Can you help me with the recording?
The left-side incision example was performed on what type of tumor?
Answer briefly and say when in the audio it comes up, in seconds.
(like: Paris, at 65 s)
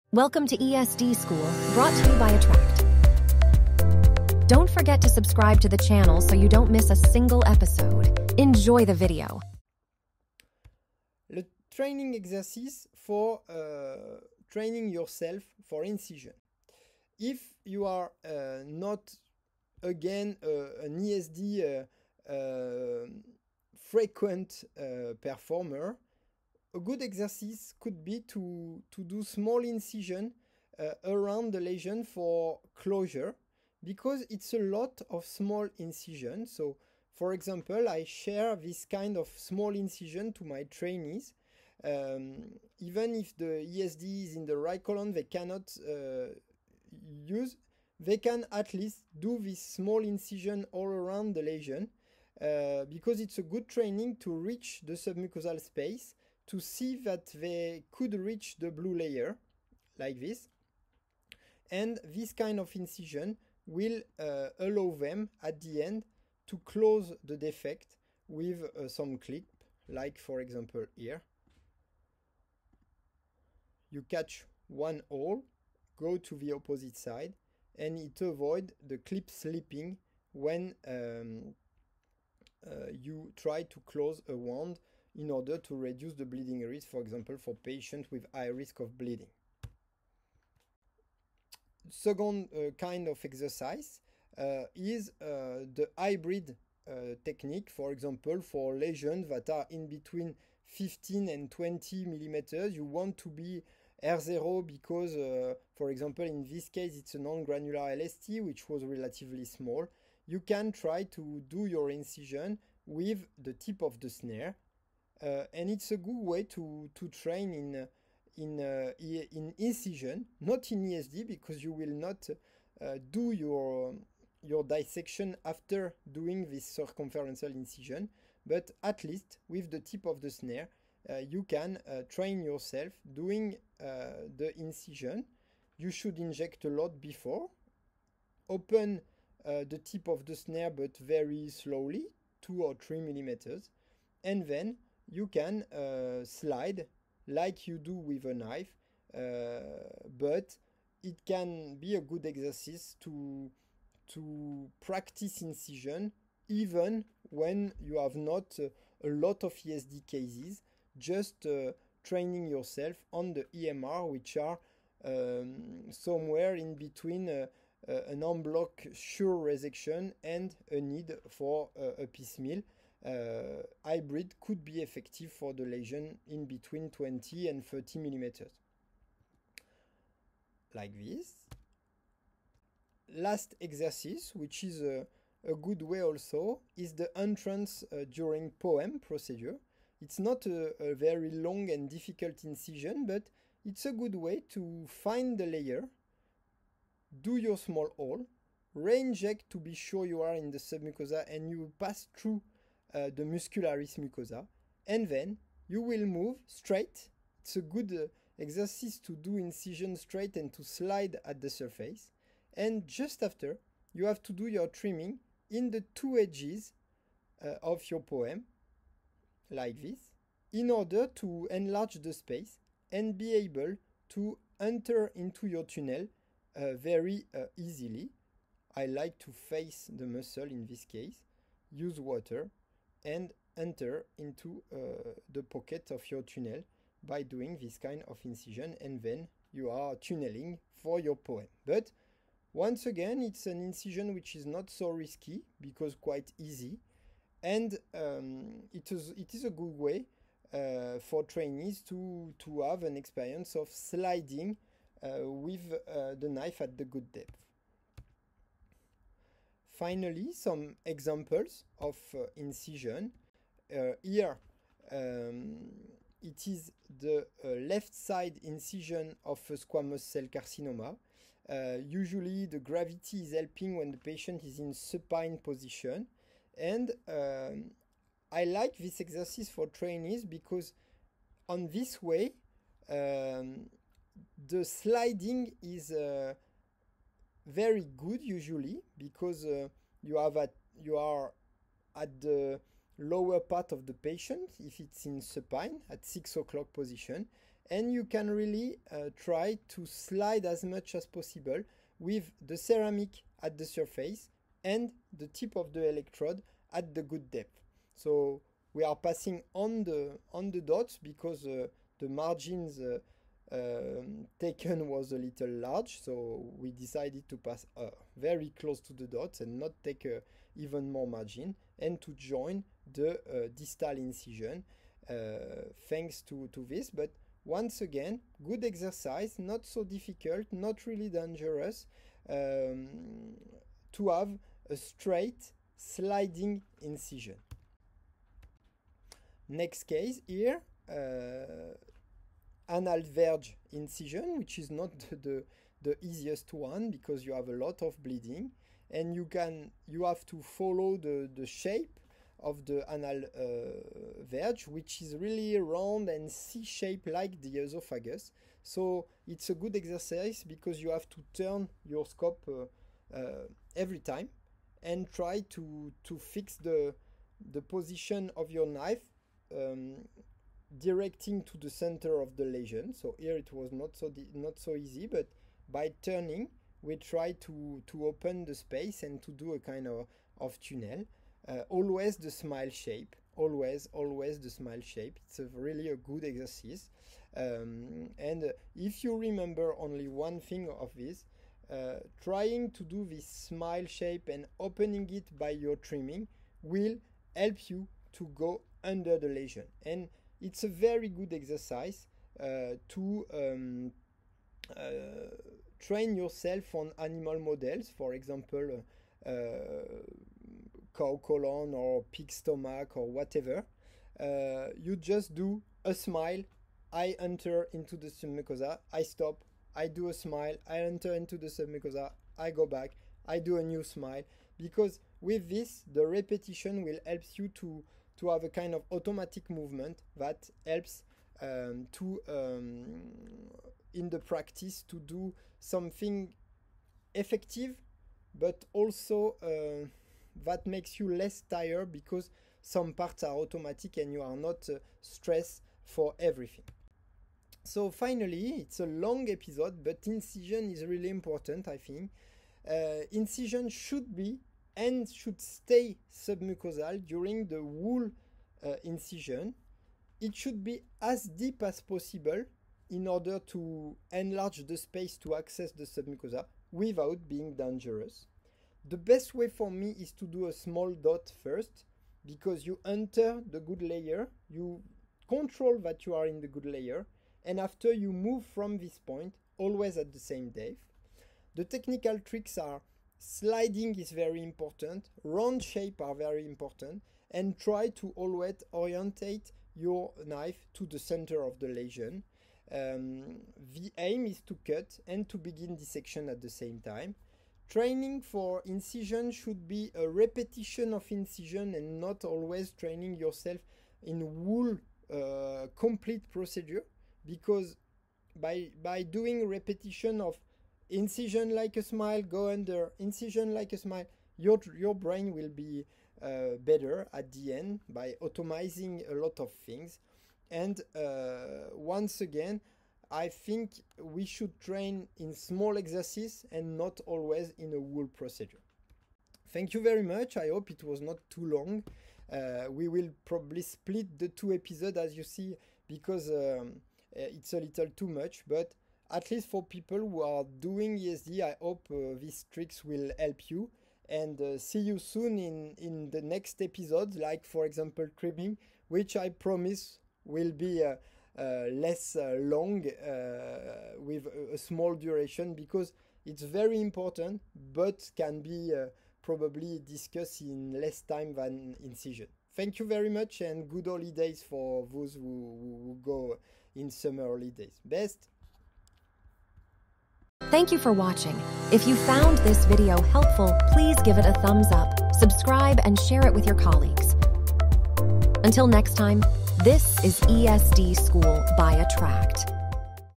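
Squamous cell carcinoma, at 269 s.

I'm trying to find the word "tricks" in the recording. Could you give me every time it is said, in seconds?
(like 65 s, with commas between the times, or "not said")
482 s, 542 s.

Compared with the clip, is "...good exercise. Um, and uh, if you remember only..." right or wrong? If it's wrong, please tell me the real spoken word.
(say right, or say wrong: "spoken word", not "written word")
right.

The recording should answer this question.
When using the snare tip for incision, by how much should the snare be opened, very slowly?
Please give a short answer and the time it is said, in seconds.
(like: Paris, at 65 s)
2 or 3 millimeters, at 142 s.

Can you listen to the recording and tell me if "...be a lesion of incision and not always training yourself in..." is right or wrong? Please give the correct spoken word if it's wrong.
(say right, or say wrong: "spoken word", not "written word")
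wrong: "repetition", not "lesion".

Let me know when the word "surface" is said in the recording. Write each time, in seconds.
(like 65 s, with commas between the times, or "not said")
211 s, 303 s.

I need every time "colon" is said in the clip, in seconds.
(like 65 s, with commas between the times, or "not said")
44 s, 411 s.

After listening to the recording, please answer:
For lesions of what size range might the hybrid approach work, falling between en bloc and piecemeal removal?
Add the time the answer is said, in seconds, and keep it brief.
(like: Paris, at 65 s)
20 to 30 millimeters, at 176 s.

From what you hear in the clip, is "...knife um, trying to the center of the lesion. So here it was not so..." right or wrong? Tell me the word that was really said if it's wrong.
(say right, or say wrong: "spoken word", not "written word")
wrong: "directing", not "trying".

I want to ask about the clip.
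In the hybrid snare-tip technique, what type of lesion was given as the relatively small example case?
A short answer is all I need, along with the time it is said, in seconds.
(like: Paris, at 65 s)
Non-granular LST, at 107 s.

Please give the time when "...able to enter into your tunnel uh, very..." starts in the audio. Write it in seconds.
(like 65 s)
223 s.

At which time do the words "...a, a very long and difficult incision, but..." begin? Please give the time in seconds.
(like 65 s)
190 s.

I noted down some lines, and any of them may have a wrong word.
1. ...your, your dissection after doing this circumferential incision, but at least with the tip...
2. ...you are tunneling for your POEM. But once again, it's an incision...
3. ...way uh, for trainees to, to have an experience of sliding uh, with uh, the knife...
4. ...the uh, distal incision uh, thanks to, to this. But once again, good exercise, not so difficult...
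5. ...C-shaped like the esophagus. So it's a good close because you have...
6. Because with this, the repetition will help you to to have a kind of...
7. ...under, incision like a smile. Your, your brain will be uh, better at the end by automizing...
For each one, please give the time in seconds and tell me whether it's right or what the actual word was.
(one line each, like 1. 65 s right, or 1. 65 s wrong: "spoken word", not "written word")
1. 123 s right
2. 239 s right
3. 249 s right
4. 322 s right
5. 356 s wrong: "exercise", not "close"
6. 424 s right
7. 512 s right.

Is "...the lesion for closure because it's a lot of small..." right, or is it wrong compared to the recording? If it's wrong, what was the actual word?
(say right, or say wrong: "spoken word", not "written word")
right.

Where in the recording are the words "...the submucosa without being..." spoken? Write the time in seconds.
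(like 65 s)
465 s.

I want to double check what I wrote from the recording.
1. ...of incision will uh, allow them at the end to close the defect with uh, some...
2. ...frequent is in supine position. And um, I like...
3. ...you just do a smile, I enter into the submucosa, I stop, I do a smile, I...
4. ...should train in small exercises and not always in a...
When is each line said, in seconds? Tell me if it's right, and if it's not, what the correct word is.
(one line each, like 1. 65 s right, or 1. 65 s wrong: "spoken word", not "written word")
1. 62 s right
2. 273 s wrong: "patient", not "frequent"
3. 414 s right
4. 524 s right.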